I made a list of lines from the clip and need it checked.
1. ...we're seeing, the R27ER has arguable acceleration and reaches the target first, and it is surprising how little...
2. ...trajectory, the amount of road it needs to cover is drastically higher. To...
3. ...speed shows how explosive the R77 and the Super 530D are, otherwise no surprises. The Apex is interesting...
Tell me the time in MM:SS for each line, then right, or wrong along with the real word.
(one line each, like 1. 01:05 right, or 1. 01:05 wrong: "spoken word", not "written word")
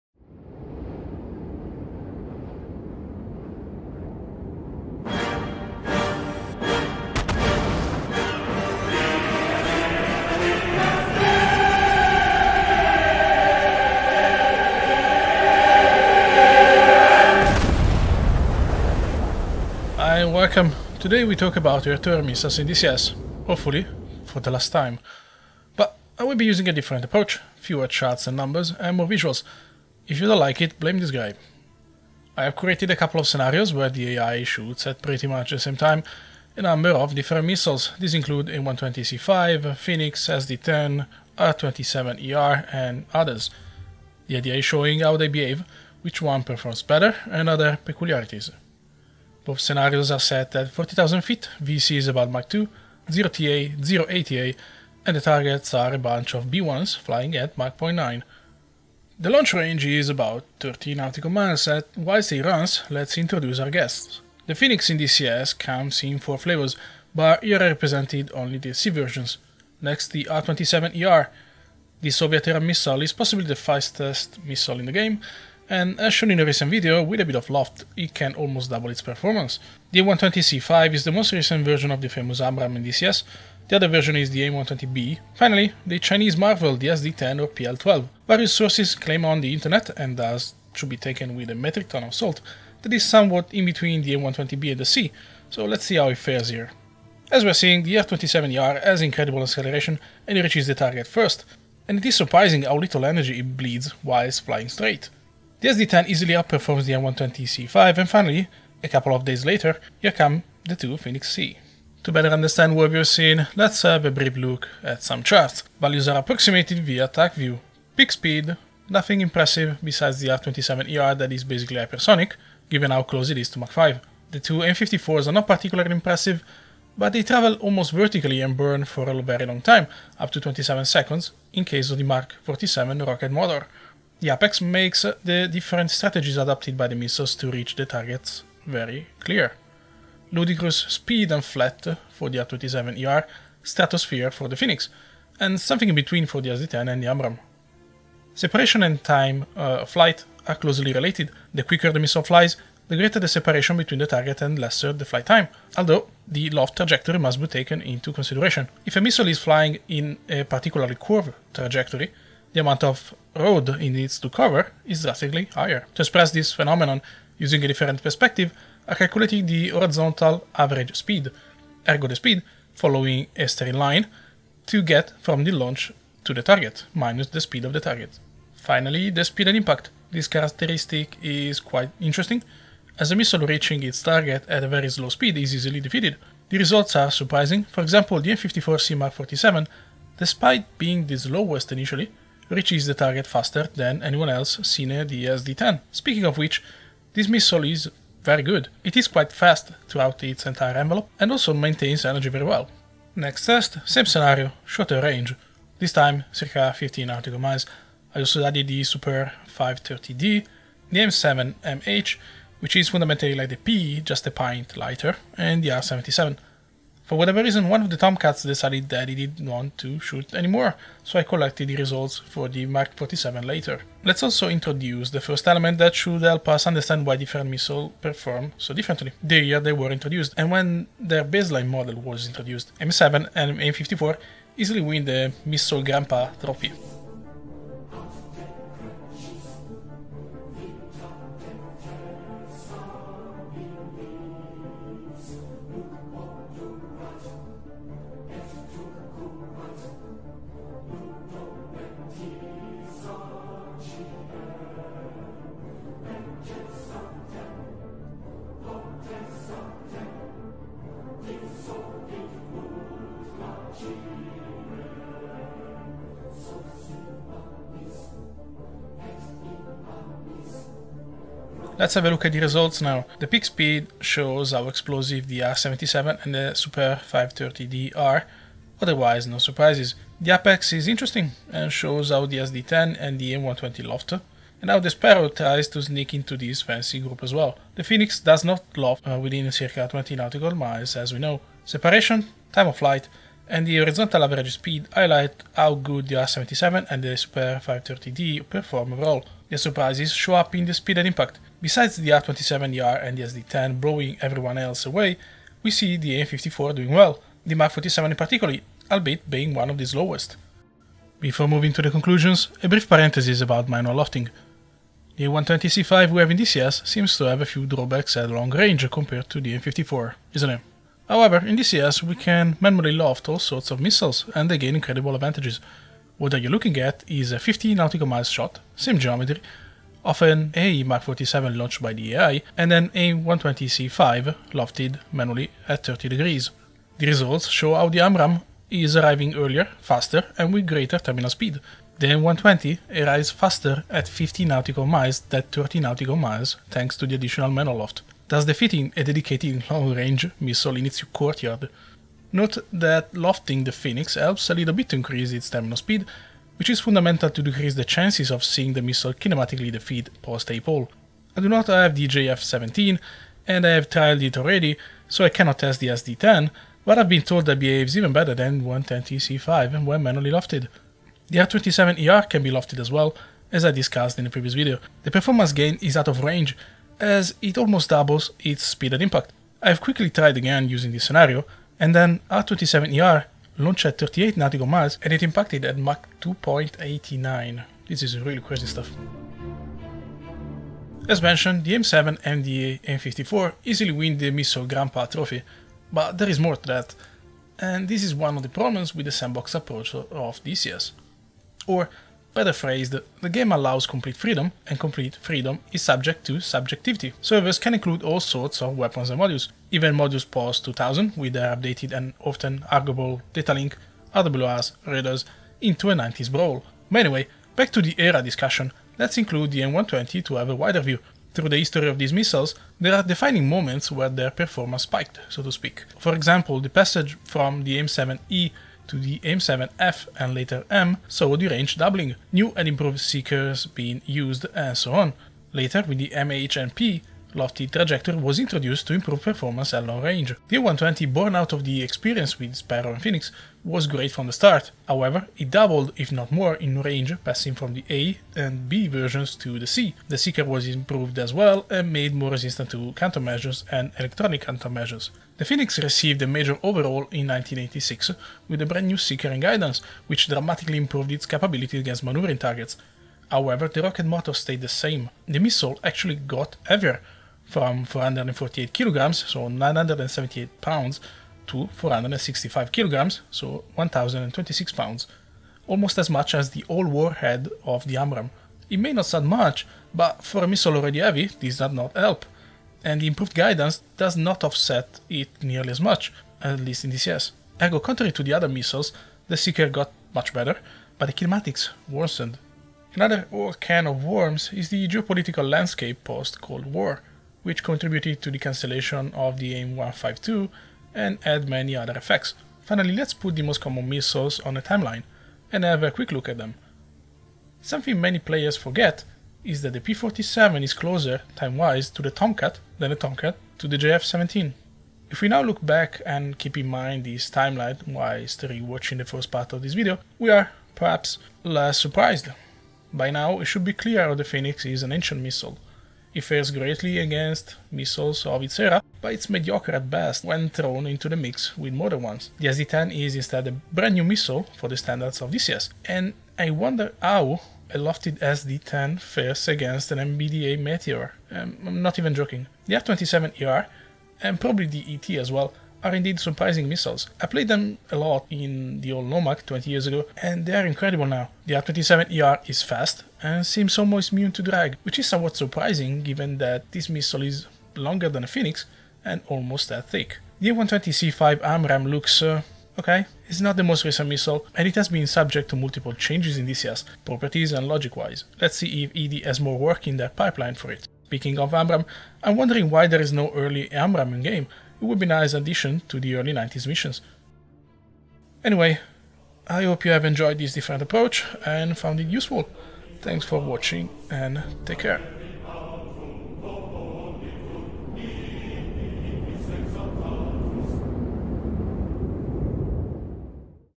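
1. 01:37 wrong: "incredible", not "arguable"
2. 02:41 right
3. 04:33 right.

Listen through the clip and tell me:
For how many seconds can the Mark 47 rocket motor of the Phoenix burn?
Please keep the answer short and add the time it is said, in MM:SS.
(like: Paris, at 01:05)
27 seconds, at 02:10.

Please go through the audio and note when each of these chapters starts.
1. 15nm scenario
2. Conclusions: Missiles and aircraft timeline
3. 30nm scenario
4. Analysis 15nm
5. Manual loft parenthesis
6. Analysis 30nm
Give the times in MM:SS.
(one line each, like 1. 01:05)
1. 03:22
2. 08:21
3. 00:35
4. 04:31
5. 05:10
6. 01:57.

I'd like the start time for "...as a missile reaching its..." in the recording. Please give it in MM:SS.
03:02.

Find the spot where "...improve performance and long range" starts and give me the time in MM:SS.
07:18.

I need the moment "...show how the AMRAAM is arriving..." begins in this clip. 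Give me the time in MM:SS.
05:37.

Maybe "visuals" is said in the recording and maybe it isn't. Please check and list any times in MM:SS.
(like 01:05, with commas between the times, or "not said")
00:29.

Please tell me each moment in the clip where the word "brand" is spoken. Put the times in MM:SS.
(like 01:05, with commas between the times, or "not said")
07:38, 08:53.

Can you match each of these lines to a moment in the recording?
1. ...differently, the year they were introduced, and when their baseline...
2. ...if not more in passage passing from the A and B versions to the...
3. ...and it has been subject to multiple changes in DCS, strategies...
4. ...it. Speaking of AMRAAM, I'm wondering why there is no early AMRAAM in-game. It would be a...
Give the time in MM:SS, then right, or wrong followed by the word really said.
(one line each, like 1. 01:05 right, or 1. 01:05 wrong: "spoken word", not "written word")
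1. 03:48 right
2. 07:25 wrong: "range", not "passage"
3. 09:24 wrong: "properties", not "strategies"
4. 09:30 right.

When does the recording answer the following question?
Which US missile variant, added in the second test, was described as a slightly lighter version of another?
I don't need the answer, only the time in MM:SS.
03:30.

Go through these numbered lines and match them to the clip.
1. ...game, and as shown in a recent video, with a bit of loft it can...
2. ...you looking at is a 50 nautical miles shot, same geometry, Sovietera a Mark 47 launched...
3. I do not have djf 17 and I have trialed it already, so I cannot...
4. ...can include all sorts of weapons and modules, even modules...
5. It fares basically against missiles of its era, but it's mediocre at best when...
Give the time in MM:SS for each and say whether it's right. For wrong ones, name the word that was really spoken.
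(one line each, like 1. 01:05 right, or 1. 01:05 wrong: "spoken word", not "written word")
1. 01:14 right
2. 05:26 wrong: "Often", not "Sovietera"
3. 06:01 right
4. 06:47 right
5. 08:46 wrong: "greatly", not "basically".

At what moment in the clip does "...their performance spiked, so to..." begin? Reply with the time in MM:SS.
07:04.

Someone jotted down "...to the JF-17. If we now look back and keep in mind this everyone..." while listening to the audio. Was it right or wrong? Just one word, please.
wrong.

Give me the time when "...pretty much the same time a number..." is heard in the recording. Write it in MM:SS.
00:35.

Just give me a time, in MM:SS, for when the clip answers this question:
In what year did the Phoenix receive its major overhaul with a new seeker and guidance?
07:37.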